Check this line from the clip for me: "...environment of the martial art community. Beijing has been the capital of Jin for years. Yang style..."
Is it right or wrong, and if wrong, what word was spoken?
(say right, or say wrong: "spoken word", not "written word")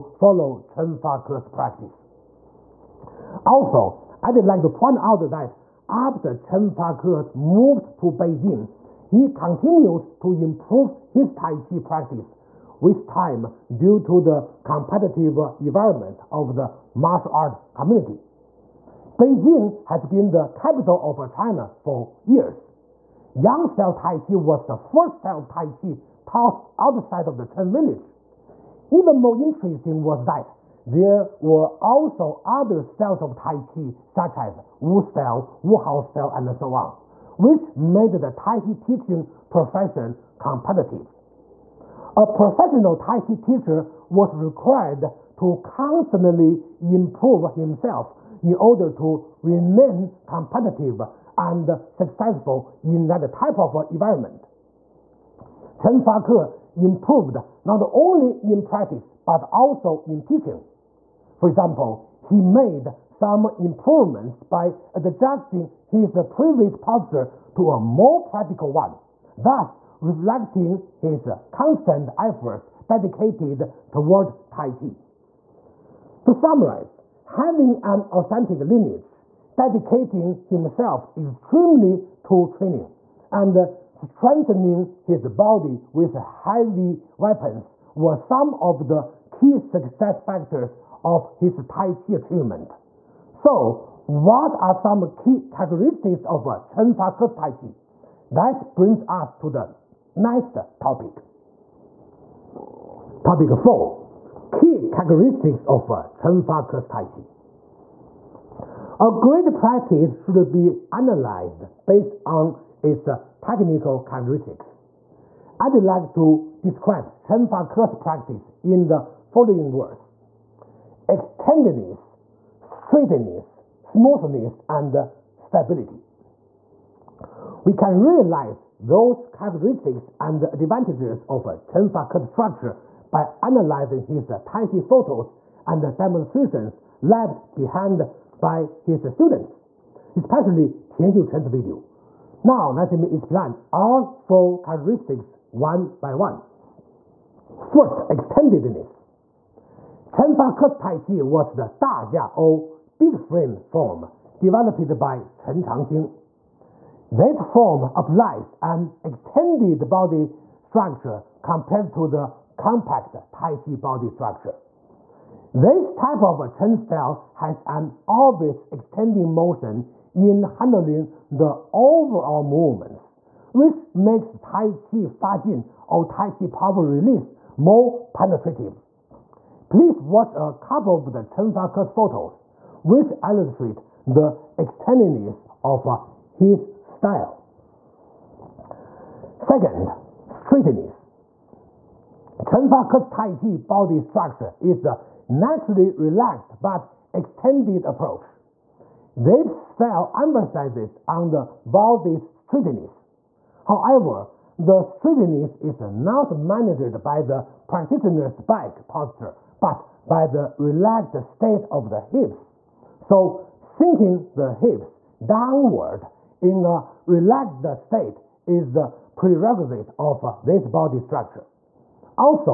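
wrong: "China", not "Jin".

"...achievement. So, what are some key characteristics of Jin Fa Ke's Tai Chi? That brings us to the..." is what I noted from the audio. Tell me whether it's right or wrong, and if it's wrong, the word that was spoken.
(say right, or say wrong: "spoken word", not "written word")
wrong: "Chen", not "Jin".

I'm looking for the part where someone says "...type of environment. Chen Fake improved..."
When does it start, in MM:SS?
00:53.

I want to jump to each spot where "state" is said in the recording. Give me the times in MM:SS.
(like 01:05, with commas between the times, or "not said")
03:31, 03:37.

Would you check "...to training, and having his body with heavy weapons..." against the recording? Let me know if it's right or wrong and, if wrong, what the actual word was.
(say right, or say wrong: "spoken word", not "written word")
wrong: "strengthening", not "having".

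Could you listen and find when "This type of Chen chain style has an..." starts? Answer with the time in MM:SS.
02:45.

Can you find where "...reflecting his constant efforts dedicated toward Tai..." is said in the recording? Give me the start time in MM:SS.
01:10.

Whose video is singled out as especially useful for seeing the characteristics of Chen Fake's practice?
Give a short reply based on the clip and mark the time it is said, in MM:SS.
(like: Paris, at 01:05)
Tian Chen, at 02:20.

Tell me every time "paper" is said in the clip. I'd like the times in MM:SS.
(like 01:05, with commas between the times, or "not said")
not said.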